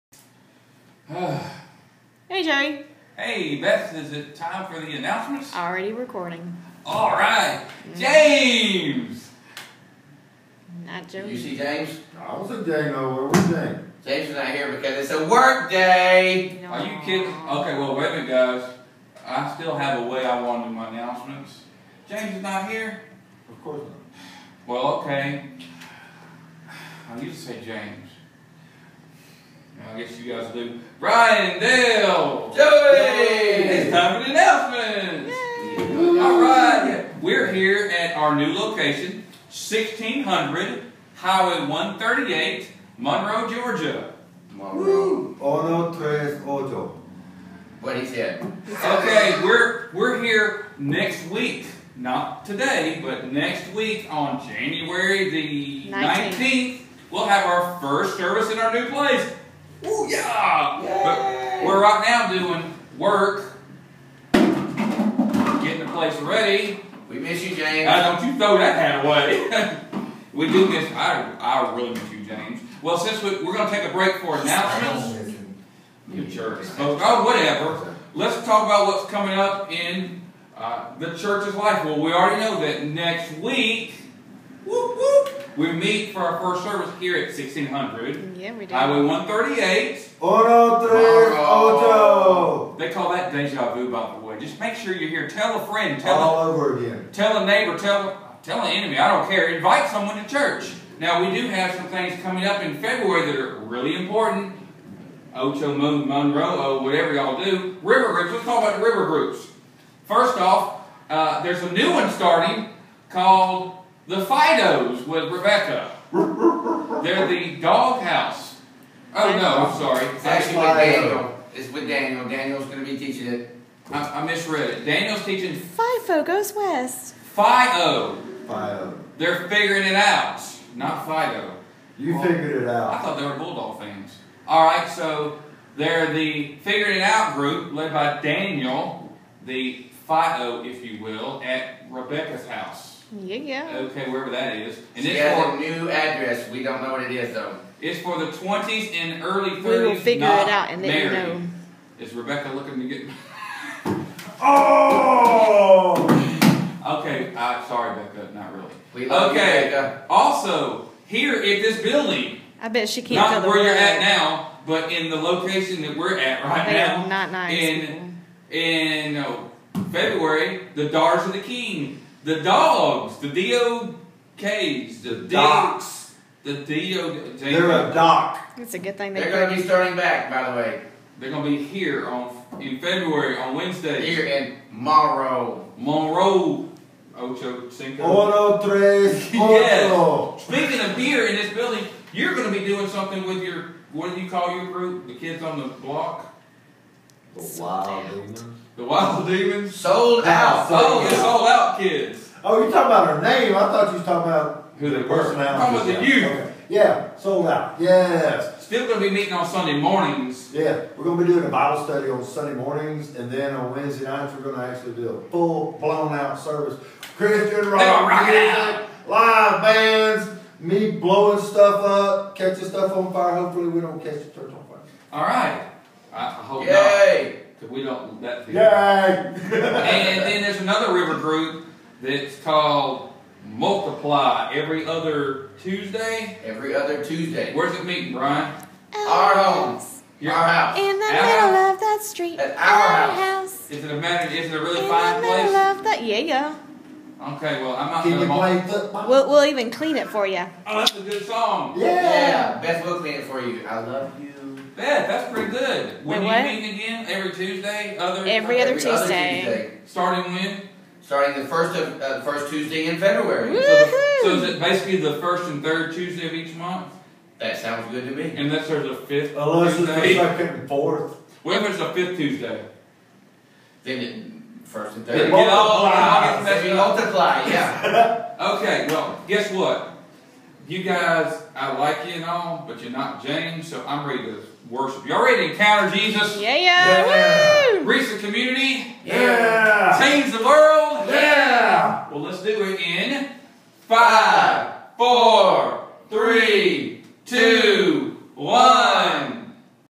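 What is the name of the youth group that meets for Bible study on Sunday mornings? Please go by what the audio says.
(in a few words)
Sold Out Kids.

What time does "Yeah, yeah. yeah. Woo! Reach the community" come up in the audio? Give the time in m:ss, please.
4:46.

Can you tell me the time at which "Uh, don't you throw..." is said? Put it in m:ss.
1:07.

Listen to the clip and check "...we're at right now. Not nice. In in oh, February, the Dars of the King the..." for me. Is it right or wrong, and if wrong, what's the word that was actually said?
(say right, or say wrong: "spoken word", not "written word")
right.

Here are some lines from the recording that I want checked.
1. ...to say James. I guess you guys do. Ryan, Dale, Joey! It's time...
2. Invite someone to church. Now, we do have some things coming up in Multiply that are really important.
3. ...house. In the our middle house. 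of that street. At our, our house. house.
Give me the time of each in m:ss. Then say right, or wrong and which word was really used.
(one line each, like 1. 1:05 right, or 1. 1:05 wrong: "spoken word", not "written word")
1. 0:27 right
2. 1:39 wrong: "February", not "Multiply"
3. 4:00 right.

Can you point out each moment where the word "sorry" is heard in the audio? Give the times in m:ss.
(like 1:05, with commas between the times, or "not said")
1:59, 2:37.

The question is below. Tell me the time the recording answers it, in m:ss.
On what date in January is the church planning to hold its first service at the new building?
0:54.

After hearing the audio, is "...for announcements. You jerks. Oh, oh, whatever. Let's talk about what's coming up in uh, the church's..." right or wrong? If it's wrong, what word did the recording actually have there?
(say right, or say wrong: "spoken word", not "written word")
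right.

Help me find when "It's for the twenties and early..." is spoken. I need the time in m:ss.
2:27.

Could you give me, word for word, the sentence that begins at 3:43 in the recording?
Hopefully we don't catch the church on fire.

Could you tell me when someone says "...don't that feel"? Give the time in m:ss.
3:47.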